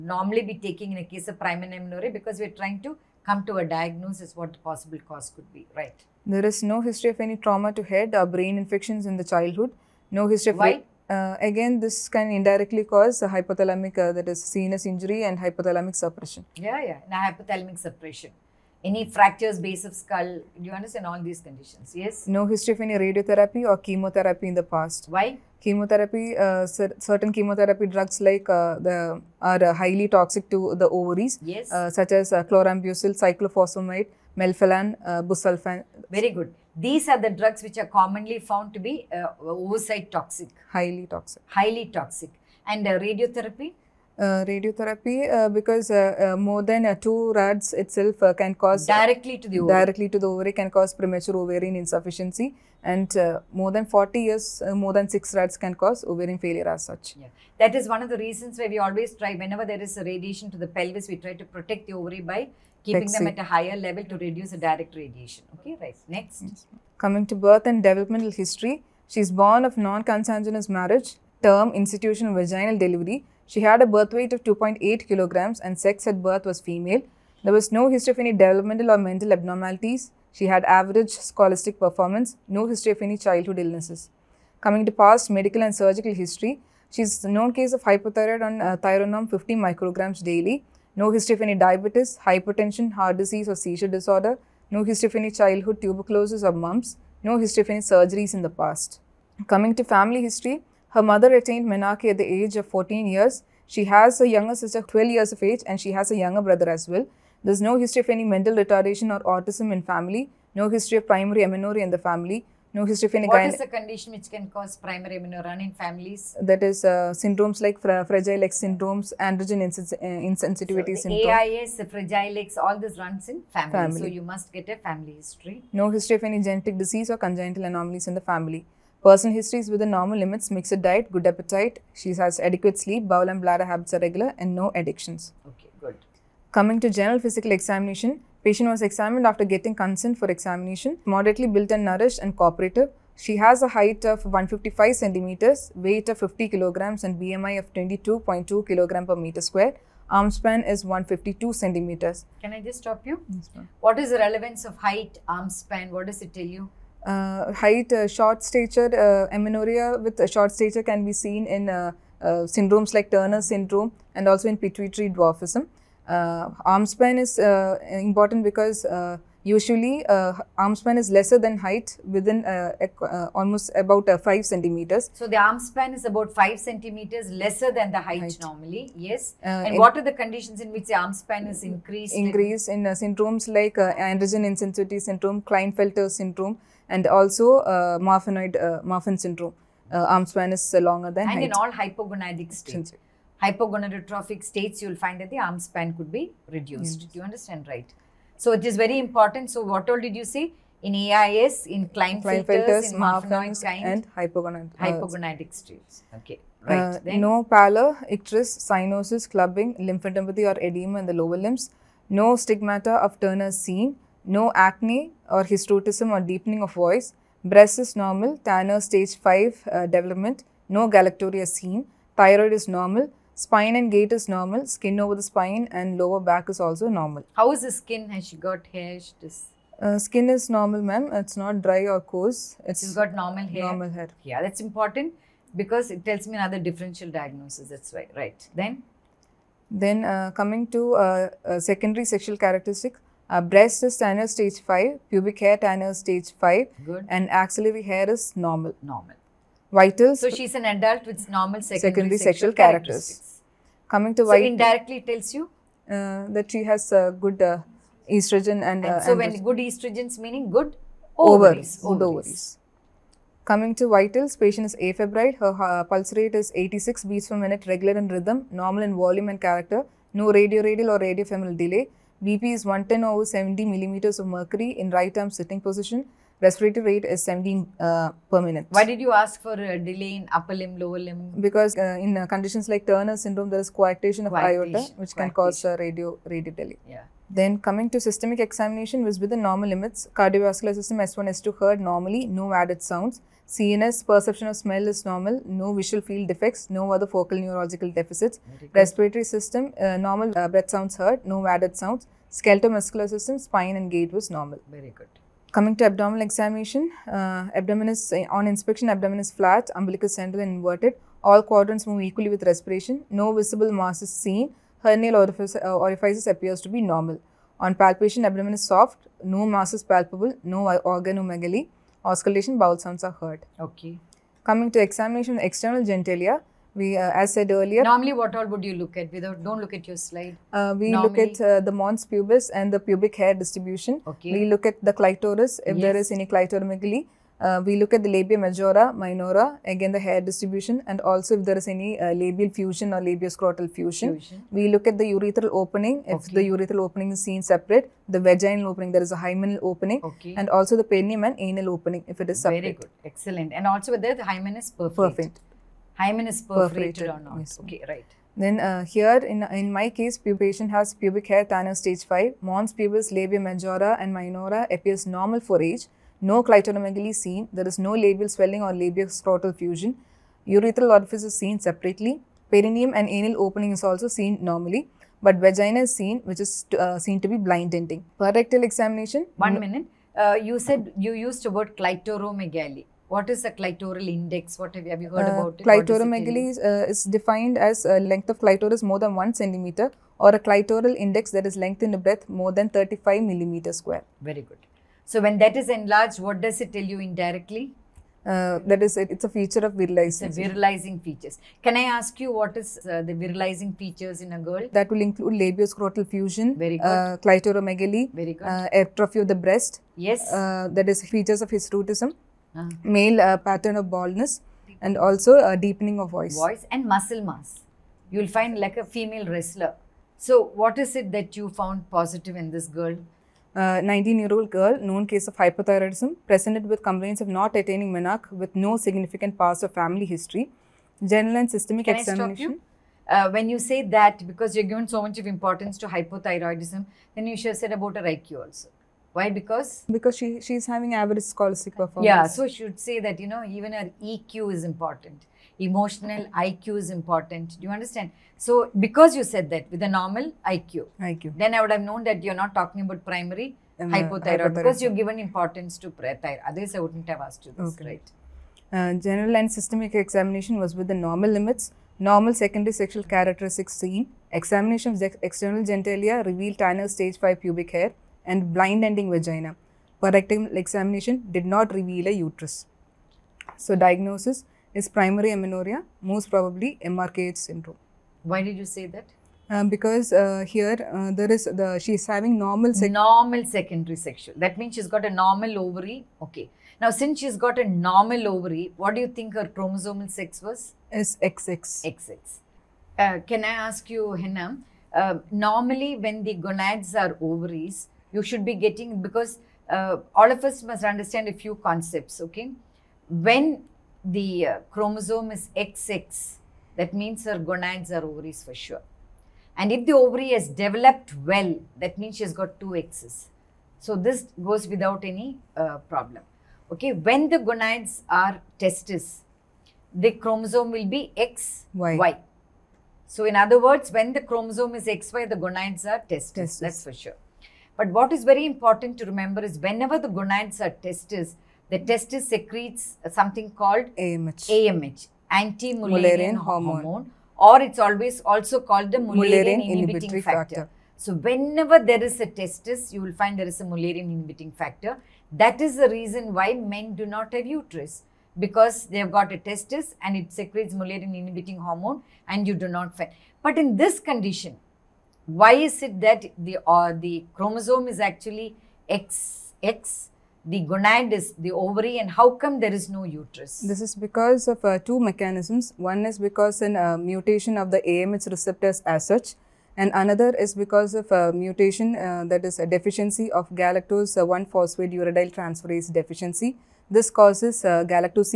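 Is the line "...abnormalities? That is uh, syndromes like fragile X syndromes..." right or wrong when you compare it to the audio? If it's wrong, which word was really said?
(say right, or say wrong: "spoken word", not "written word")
wrong: "families", not "abnormalities".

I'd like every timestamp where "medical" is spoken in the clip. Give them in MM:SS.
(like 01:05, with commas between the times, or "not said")
01:25.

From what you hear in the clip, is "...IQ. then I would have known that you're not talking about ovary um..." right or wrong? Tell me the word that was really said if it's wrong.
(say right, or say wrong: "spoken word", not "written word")
wrong: "primary", not "ovary".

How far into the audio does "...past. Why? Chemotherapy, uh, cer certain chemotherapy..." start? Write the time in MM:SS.
00:24.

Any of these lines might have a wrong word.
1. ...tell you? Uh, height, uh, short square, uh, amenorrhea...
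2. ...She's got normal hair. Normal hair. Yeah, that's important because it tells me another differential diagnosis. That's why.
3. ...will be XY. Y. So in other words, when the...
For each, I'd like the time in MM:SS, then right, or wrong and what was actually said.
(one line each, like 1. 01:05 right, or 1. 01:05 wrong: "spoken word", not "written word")
1. 02:36 wrong: "stature", not "square"
2. 03:52 right
3. 08:40 right.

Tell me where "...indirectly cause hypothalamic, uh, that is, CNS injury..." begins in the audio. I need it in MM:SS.
00:12.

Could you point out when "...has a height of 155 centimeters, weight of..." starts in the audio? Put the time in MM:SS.
02:23.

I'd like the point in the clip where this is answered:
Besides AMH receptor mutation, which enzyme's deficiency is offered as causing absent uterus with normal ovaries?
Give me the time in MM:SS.
09:33.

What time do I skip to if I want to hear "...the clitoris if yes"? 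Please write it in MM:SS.
05:34.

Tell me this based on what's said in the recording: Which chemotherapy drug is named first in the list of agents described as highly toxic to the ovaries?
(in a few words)
chlorambucil.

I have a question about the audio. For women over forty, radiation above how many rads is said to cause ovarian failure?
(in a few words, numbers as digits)
6 rads.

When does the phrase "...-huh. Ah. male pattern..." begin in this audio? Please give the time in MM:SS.
06:52.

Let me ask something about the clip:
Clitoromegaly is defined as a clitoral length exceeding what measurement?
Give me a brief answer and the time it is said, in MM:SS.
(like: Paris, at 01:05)
1 centimeter, at 06:29.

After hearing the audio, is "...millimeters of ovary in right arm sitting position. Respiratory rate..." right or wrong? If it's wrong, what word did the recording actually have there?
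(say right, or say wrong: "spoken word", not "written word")
wrong: "mercury", not "ovary".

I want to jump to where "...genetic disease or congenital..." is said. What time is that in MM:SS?
02:06.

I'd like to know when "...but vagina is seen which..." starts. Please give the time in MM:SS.
06:15.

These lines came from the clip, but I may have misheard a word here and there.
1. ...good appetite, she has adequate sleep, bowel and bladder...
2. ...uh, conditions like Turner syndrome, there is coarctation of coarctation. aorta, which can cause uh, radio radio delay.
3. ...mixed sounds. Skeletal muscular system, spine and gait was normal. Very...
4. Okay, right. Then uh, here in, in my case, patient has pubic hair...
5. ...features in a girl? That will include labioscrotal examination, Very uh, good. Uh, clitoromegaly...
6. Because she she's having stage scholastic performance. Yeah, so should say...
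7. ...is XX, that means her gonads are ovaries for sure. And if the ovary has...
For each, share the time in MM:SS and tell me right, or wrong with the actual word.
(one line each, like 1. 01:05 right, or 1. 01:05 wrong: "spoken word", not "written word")
1. 02:11 right
2. 04:42 right
3. 05:01 wrong: "added", not "mixed"
4. 05:57 right
5. 06:43 wrong: "fusion", not "examination"
6. 07:19 wrong: "average", not "stage"
7. 08:25 right.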